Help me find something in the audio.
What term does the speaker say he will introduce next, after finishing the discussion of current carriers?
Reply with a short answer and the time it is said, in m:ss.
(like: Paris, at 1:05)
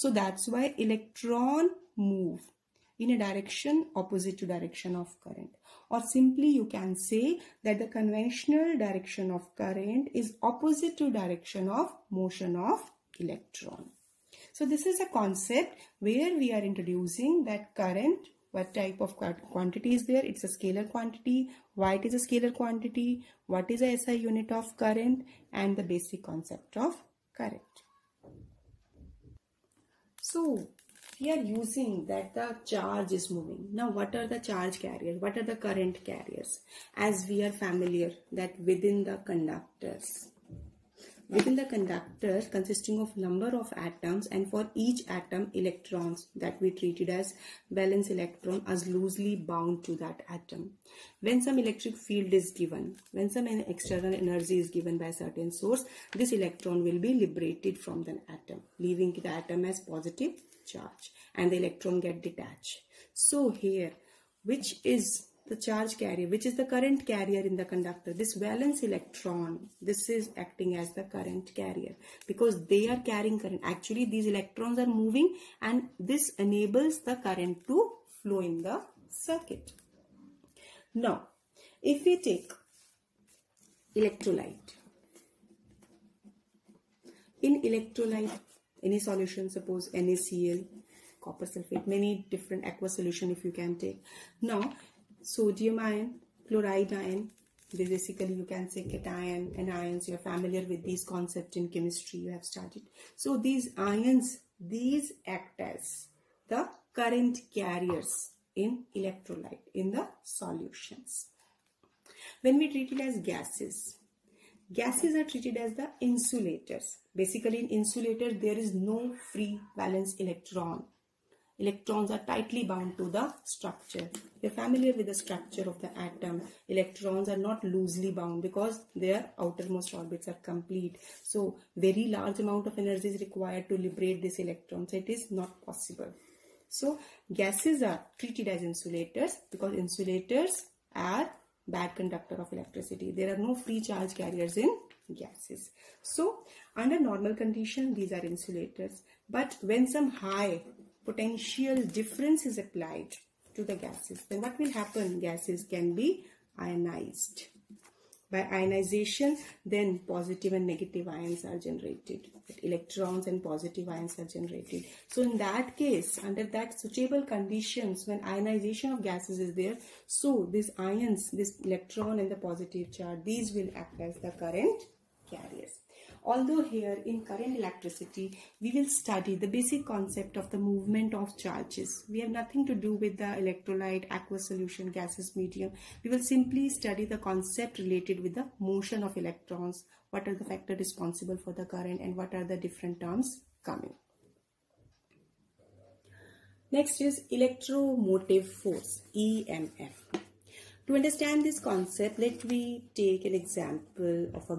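electromotive force, at 3:17.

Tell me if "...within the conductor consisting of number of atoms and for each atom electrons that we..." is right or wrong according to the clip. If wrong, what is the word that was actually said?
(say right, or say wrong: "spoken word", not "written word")
right.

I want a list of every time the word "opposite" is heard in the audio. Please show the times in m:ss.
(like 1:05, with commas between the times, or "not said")
0:03, 0:10.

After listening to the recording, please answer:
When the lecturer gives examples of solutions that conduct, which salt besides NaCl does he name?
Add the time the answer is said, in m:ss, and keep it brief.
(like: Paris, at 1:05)
copper sulfate, at 1:31.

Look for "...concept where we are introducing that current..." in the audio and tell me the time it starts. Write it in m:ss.
0:15.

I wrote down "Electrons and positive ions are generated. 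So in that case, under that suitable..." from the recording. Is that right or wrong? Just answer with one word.
right.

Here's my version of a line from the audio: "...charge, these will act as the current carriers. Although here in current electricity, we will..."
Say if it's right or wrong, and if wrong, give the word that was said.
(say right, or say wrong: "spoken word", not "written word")
right.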